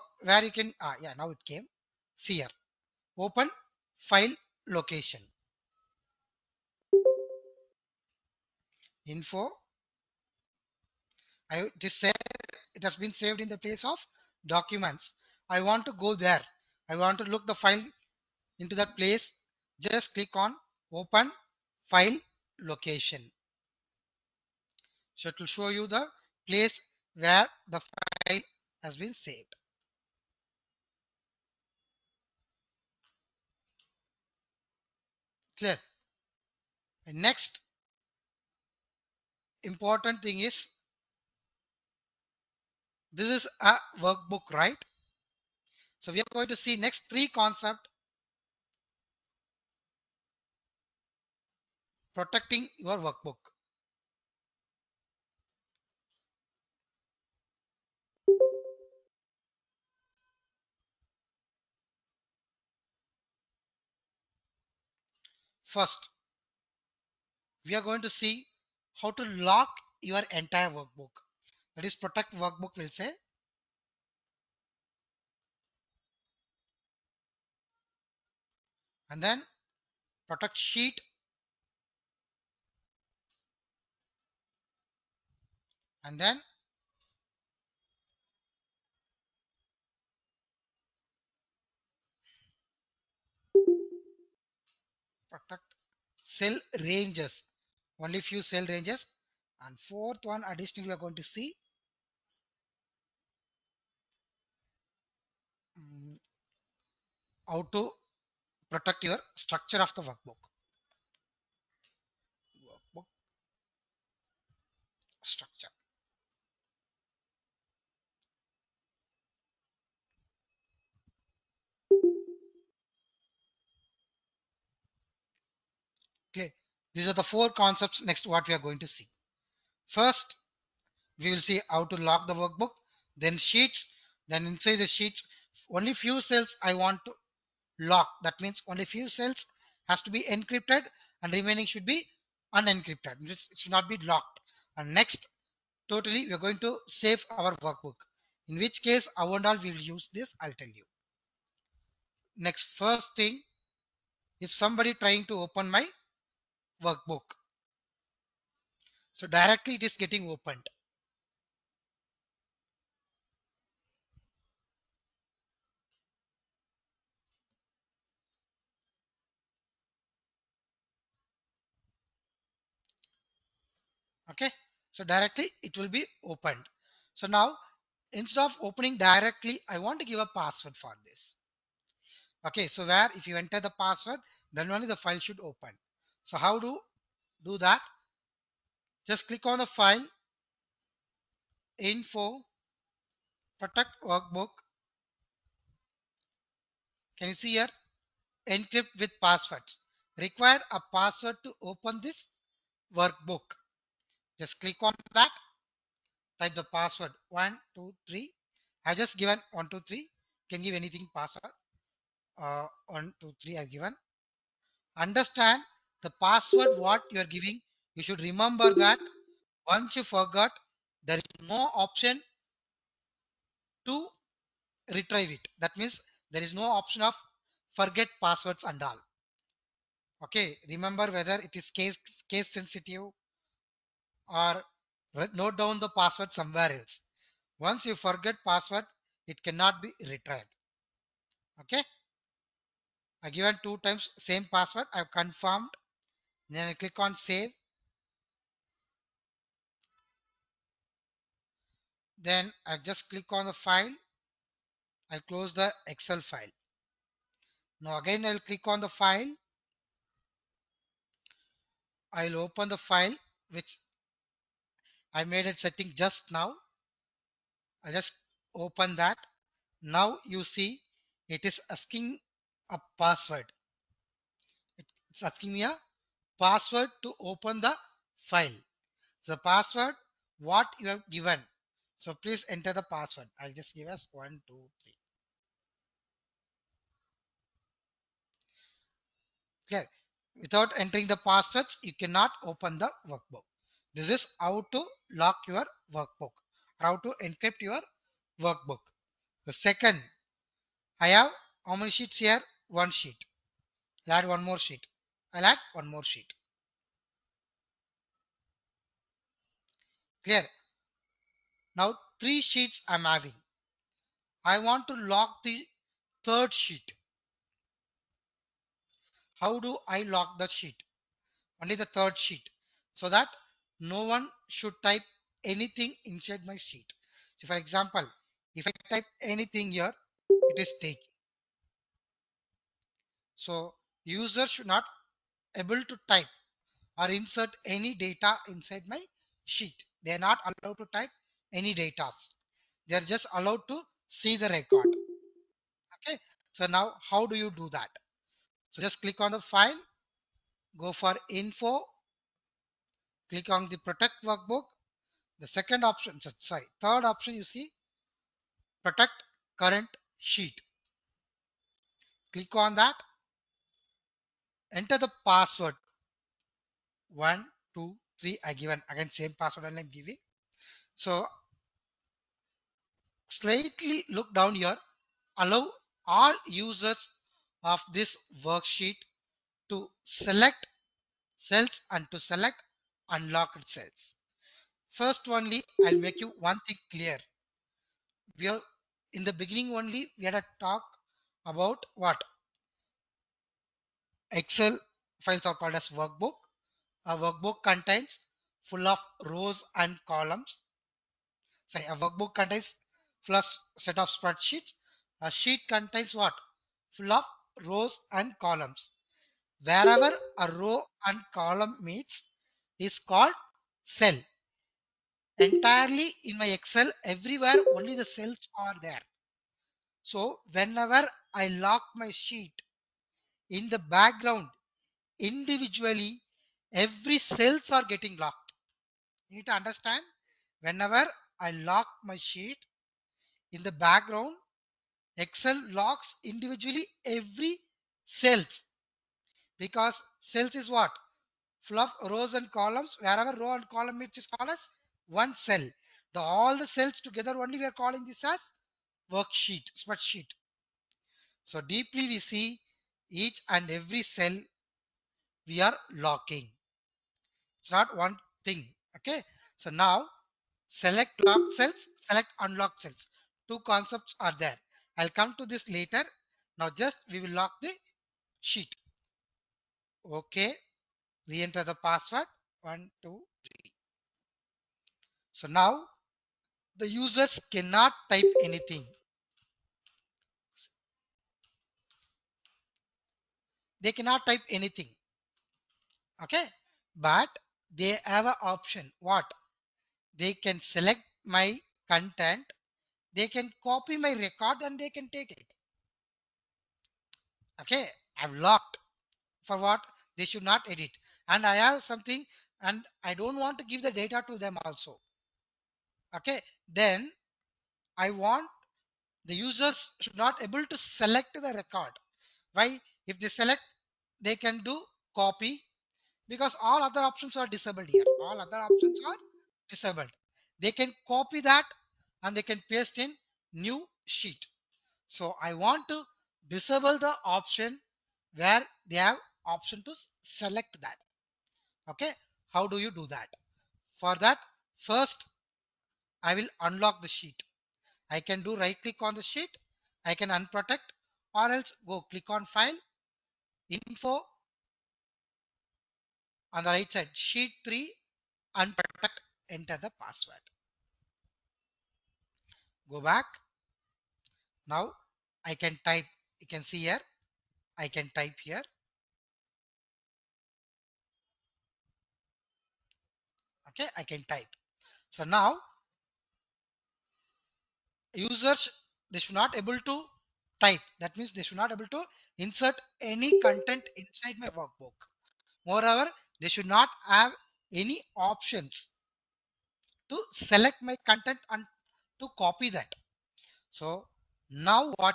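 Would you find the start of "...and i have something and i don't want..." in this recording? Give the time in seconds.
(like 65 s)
501 s.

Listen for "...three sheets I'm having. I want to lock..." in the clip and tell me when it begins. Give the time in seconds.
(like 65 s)
312 s.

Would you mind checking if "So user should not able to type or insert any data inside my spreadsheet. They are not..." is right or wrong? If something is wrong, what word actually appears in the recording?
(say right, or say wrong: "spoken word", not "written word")
wrong: "sheet", not "spreadsheet".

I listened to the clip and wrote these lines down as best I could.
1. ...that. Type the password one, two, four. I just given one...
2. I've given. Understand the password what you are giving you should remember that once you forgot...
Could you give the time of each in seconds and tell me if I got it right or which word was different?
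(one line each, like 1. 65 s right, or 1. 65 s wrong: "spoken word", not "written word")
1. 205 s wrong: "three", not "four"
2. 213 s right.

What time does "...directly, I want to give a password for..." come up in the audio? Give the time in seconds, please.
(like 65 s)
178 s.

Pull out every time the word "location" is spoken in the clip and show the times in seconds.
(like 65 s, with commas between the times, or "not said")
4 s, 22 s.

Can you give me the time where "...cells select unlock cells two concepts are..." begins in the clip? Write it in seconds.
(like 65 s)
461 s.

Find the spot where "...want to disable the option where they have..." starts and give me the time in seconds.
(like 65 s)
525 s.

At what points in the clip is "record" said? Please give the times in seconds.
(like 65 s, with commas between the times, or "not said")
344 s, 494 s, 511 s.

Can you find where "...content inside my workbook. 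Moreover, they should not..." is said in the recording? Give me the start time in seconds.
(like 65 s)
573 s.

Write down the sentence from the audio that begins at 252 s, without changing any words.
Then I just click on the file.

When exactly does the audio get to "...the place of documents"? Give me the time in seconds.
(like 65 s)
13 s.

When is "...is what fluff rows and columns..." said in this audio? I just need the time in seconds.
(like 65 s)
440 s.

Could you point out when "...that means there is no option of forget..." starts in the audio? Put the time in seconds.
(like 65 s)
225 s.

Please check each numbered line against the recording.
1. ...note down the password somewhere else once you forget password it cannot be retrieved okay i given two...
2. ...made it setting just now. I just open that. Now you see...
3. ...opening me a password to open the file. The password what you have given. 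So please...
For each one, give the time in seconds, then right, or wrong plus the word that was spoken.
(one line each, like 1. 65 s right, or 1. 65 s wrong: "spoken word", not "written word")
1. 235 s right
2. 265 s right
3. 275 s wrong: "asking", not "opening".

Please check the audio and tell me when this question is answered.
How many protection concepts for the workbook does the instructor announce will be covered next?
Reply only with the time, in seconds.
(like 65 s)
127 s.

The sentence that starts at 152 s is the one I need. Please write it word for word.
Next, first thing, if somebody trying to open my workbook.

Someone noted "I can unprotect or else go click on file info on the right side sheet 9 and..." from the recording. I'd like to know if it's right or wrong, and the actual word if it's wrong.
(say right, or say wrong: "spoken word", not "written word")
wrong: "3", not "9".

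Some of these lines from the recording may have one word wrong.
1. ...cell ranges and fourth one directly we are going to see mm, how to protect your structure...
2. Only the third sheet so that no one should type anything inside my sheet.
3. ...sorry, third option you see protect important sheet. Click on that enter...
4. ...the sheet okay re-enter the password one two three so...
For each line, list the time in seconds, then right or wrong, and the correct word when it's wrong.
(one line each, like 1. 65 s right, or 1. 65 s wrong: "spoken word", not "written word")
1. 98 s wrong: "additionally", not "directly"
2. 321 s right
3. 356 s wrong: "current", not "important"
4. 467 s right.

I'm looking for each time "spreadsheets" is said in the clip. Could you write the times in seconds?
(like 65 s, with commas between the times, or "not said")
404 s, 449 s.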